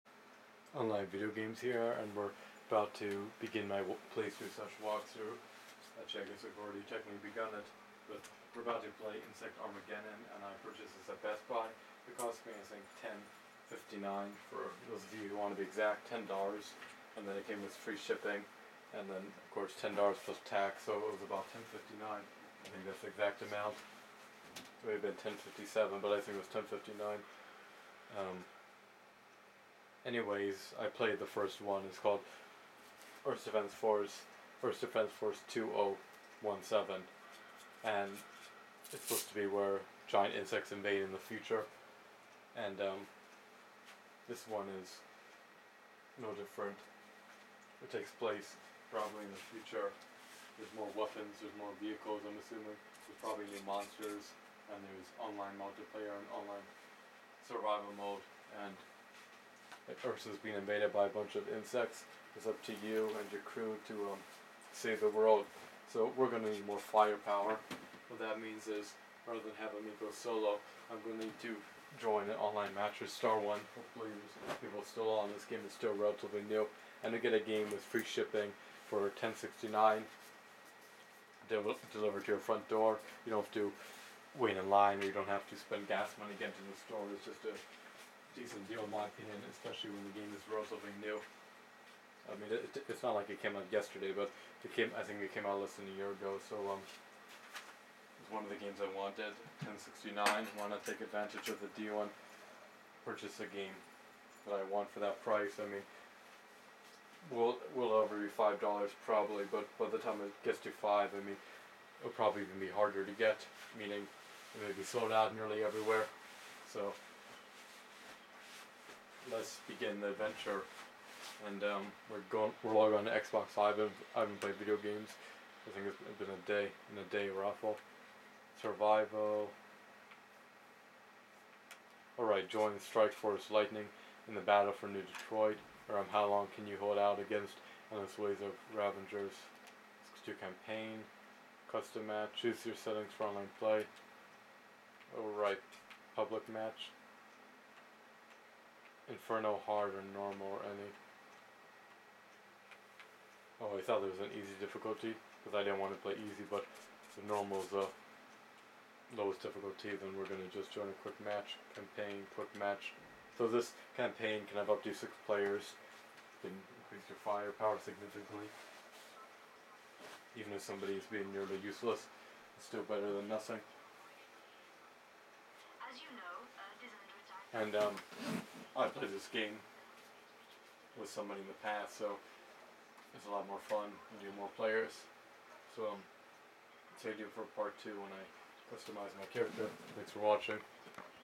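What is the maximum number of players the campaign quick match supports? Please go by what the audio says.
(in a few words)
6.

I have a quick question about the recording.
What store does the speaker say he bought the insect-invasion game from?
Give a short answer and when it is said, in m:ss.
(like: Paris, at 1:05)
Best Buy, at 0:11.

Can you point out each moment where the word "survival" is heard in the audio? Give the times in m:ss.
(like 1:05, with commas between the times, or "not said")
0:57, 2:08.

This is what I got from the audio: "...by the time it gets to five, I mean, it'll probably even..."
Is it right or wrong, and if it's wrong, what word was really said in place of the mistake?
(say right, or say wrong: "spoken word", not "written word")
right.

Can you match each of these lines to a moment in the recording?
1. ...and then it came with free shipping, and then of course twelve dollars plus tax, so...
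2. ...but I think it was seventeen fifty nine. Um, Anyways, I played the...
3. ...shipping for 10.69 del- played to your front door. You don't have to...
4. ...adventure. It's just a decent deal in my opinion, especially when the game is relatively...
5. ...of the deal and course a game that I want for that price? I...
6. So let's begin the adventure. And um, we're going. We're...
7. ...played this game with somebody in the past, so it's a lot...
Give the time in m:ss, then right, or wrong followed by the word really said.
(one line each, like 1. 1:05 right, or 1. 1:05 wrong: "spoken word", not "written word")
1. 0:17 wrong: "ten", not "twelve"
2. 0:25 wrong: "ten", not "seventeen"
3. 1:18 wrong: "delivered", not "played"
4. 1:26 wrong: "store", not "adventure"
5. 1:41 wrong: "purchase", not "course"
6. 1:56 right
7. 2:58 right.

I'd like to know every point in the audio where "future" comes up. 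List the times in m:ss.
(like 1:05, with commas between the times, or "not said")
0:41, 0:49.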